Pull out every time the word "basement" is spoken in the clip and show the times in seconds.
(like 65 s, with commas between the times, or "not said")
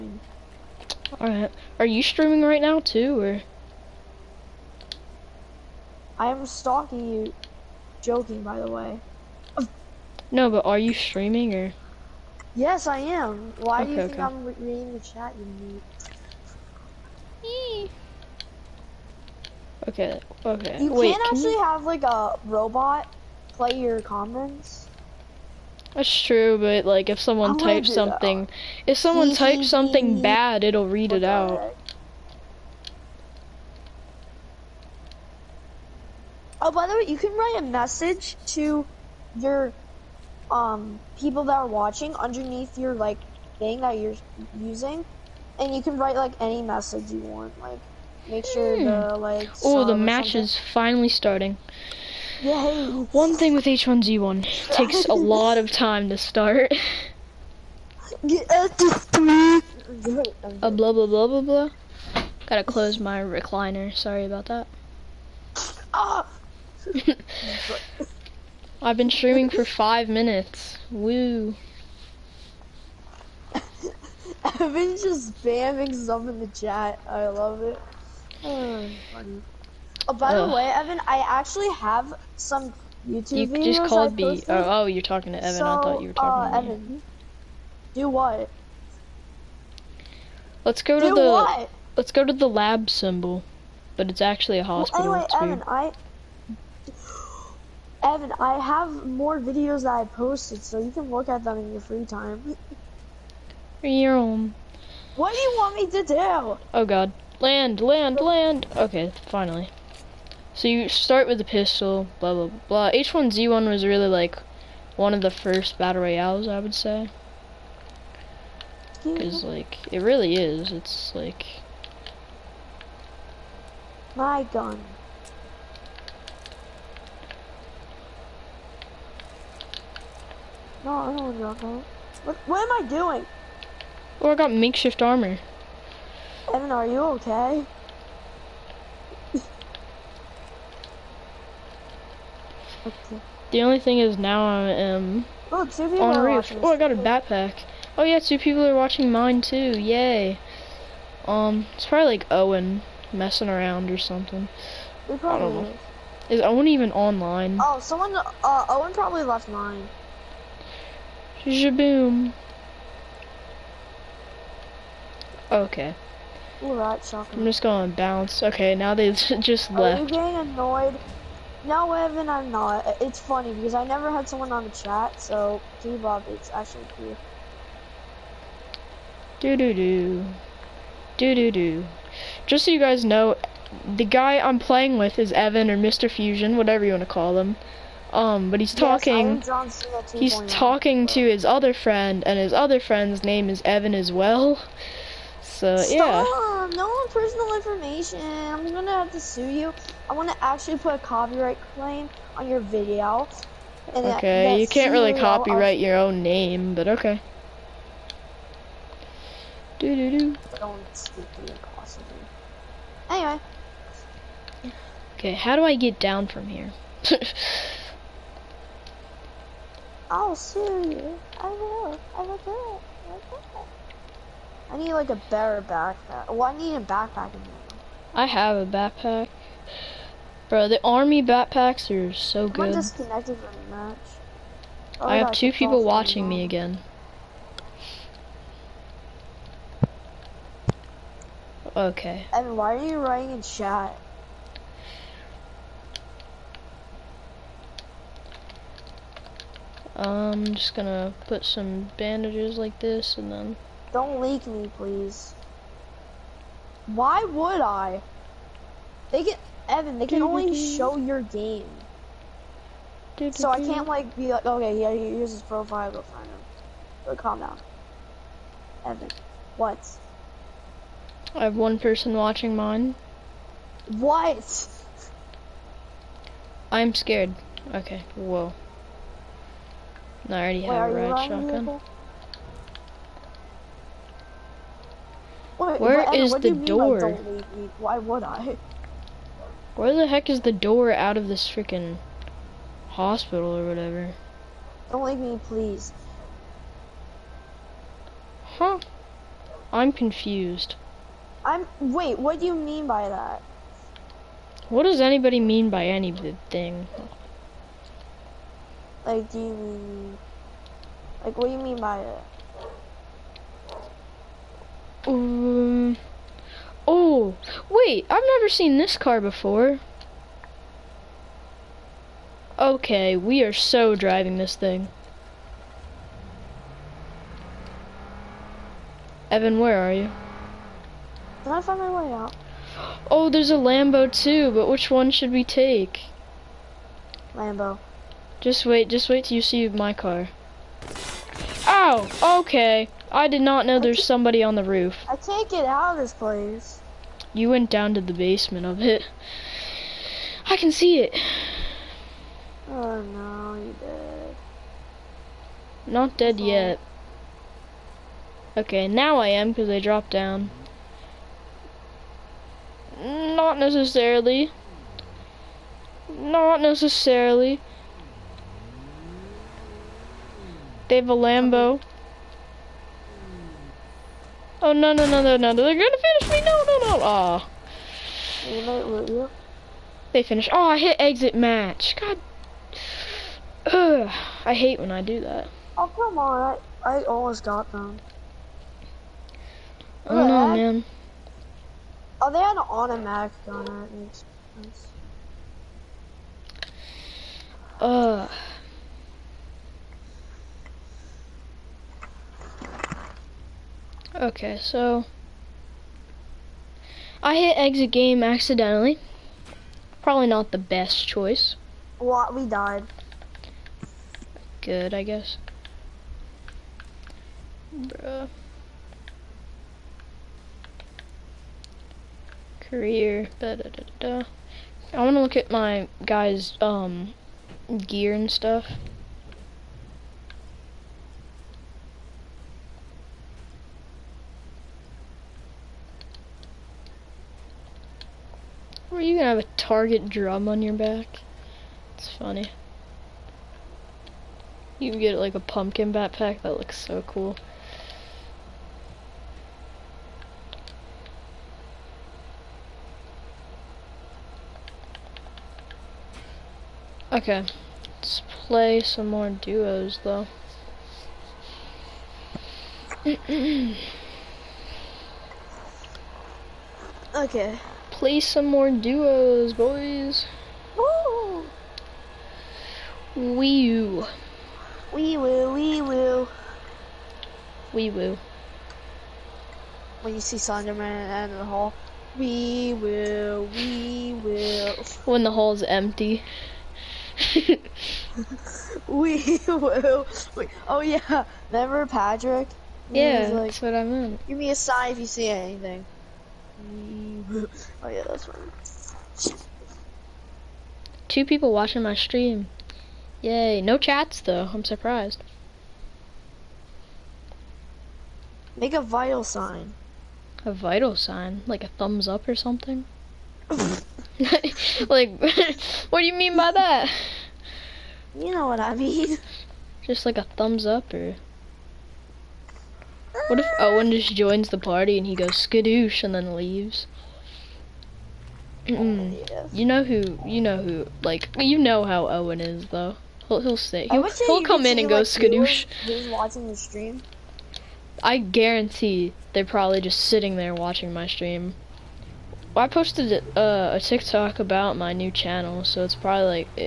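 348 s.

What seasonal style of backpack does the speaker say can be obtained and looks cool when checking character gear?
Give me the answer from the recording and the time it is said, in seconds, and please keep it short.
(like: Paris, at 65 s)
pumpkin backpack, at 445 s.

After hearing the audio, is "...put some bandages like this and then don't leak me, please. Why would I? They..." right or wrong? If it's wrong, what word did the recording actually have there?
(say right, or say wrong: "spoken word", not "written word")
right.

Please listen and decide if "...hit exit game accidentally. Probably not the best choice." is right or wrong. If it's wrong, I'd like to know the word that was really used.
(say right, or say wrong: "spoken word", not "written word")
right.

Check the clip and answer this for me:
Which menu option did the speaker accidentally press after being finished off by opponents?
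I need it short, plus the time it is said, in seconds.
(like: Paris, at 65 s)
exit match, at 380 s.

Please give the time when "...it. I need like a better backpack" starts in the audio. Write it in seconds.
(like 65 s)
222 s.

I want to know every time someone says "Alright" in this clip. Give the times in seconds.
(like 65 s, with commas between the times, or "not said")
1 s, 166 s.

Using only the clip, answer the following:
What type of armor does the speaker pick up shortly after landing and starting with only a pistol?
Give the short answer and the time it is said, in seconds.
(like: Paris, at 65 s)
makeshift armor, at 134 s.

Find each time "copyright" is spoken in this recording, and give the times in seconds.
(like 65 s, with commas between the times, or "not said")
200 s, 205 s.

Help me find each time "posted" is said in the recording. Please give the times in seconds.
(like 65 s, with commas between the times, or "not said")
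100 s, 542 s.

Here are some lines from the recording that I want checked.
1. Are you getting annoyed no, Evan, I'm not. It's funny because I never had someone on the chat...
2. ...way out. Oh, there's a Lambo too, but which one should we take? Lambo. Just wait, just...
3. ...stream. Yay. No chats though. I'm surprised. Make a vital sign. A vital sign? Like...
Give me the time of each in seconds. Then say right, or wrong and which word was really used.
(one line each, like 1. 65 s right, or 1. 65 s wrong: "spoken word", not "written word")
1. 170 s right
2. 332 s right
3. 501 s right.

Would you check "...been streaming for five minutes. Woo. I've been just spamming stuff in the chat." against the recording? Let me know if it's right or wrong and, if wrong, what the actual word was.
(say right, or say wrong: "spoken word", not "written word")
right.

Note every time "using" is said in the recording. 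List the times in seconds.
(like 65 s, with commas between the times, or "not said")
44 s.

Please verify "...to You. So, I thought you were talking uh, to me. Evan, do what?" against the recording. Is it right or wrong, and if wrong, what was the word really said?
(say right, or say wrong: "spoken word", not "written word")
wrong: "Evan", not "You".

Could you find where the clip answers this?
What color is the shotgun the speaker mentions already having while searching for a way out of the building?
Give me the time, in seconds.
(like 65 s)
280 s.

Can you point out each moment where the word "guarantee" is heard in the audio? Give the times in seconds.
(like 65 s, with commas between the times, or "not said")
538 s.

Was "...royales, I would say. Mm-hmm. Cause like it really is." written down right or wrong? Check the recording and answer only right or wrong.
right.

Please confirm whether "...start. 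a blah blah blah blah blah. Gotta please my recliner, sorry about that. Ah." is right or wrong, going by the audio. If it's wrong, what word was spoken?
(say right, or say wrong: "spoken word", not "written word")
wrong: "close", not "please".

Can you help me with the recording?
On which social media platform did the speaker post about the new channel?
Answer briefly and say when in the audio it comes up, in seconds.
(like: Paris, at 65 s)
TikTok, at 543 s.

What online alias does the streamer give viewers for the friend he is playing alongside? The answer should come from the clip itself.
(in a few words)
Mr. Fusion.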